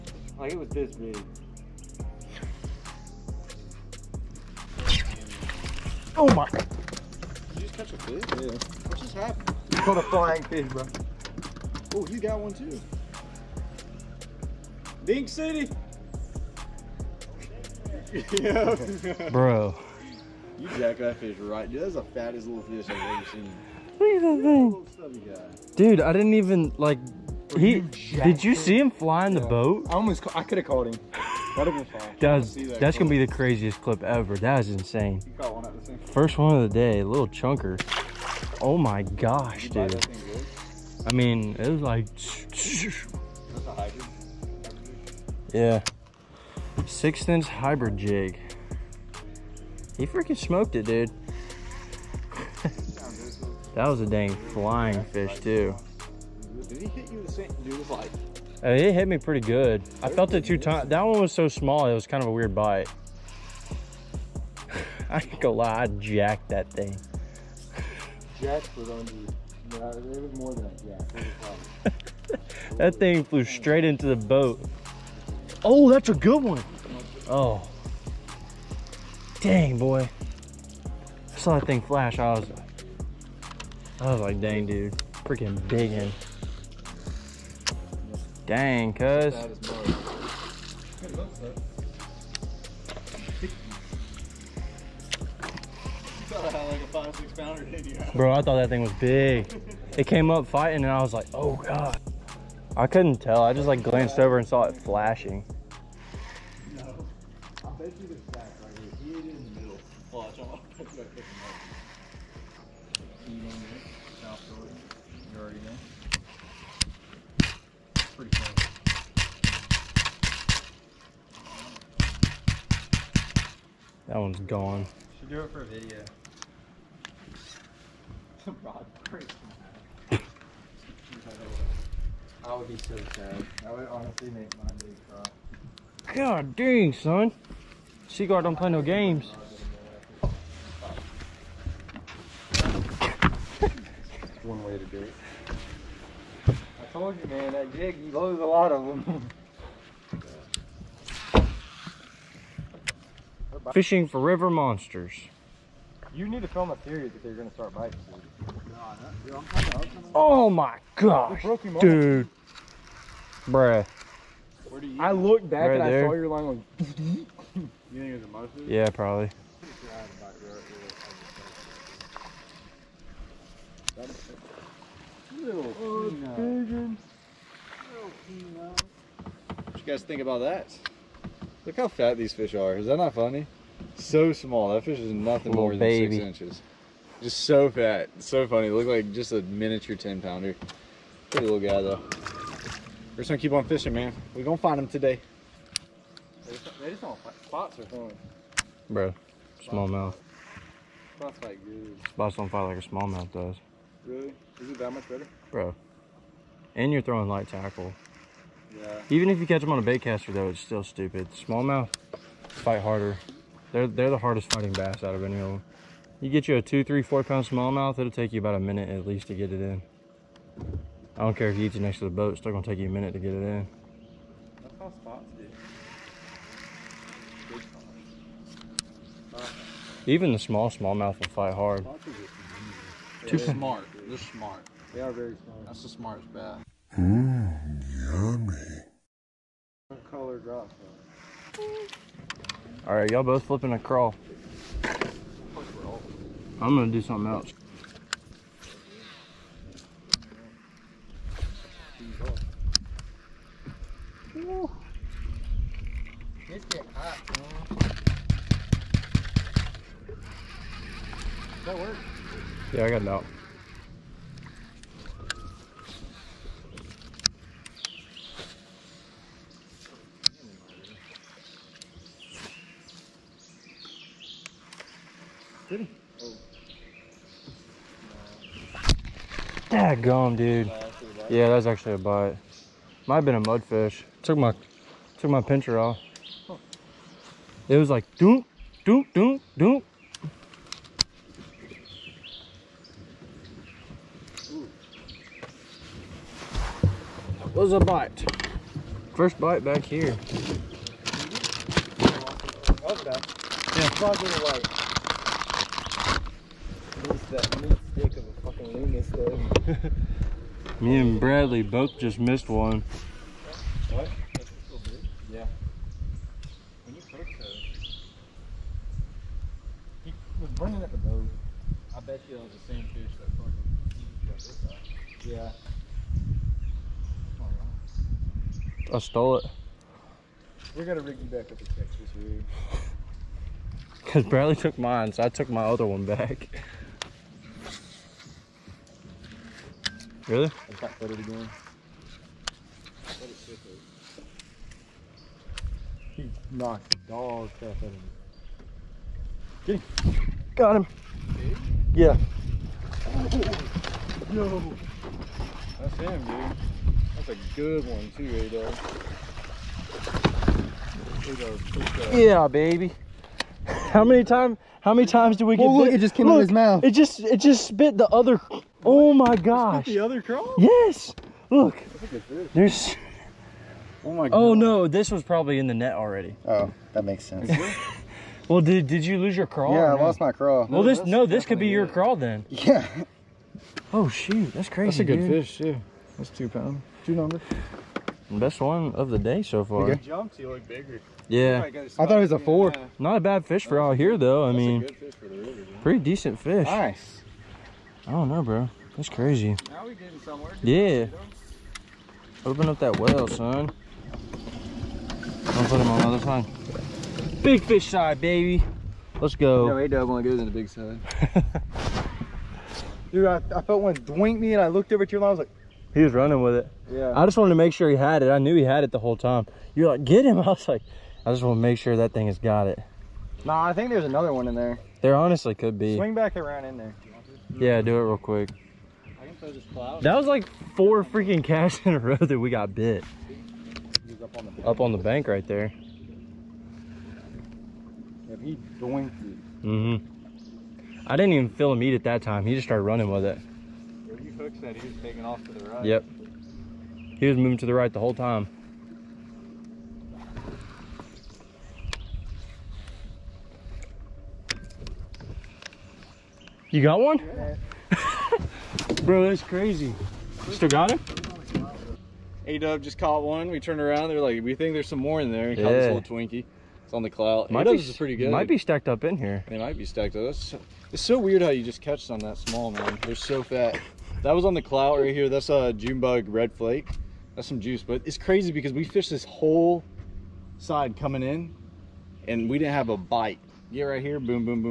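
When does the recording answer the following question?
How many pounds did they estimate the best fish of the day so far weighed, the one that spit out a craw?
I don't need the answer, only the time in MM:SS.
06:26.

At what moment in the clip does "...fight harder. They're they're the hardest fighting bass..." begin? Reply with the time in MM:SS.
03:32.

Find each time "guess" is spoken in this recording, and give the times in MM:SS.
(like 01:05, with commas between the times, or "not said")
not said.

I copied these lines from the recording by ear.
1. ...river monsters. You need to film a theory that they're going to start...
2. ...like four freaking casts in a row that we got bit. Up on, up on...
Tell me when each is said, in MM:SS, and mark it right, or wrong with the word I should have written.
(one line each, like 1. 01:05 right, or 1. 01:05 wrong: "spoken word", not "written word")
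1. 02:34 right
2. 07:10 right.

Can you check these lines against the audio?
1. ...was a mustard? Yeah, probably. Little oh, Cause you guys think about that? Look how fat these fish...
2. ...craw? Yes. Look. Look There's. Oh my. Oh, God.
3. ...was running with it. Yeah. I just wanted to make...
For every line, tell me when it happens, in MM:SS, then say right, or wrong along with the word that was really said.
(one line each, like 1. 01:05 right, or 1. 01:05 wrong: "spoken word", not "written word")
1. 02:48 wrong: "What", not "Cause"
2. 06:10 right
3. 06:56 right.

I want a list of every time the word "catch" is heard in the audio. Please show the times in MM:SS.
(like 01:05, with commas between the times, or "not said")
00:07, 03:29, 07:51.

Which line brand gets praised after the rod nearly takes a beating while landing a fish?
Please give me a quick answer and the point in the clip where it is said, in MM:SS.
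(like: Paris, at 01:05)
Seaguar, at 02:18.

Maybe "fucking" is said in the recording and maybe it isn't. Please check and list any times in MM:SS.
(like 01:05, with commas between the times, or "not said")
05:03, 05:24.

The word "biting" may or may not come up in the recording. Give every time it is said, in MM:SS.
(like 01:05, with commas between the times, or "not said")
02:33, 02:37.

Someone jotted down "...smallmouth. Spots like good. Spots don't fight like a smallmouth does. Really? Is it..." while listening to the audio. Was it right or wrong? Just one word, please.
right.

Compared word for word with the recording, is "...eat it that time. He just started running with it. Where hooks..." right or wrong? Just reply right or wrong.
right.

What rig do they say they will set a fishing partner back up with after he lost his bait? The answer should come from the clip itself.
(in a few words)
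Texas rig.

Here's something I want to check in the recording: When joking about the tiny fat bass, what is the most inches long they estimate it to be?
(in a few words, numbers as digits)
6.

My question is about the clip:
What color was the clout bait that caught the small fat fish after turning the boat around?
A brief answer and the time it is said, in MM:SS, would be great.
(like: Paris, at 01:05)
June bug red flake, at 07:55.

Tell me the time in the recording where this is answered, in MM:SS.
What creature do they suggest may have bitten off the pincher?
04:43.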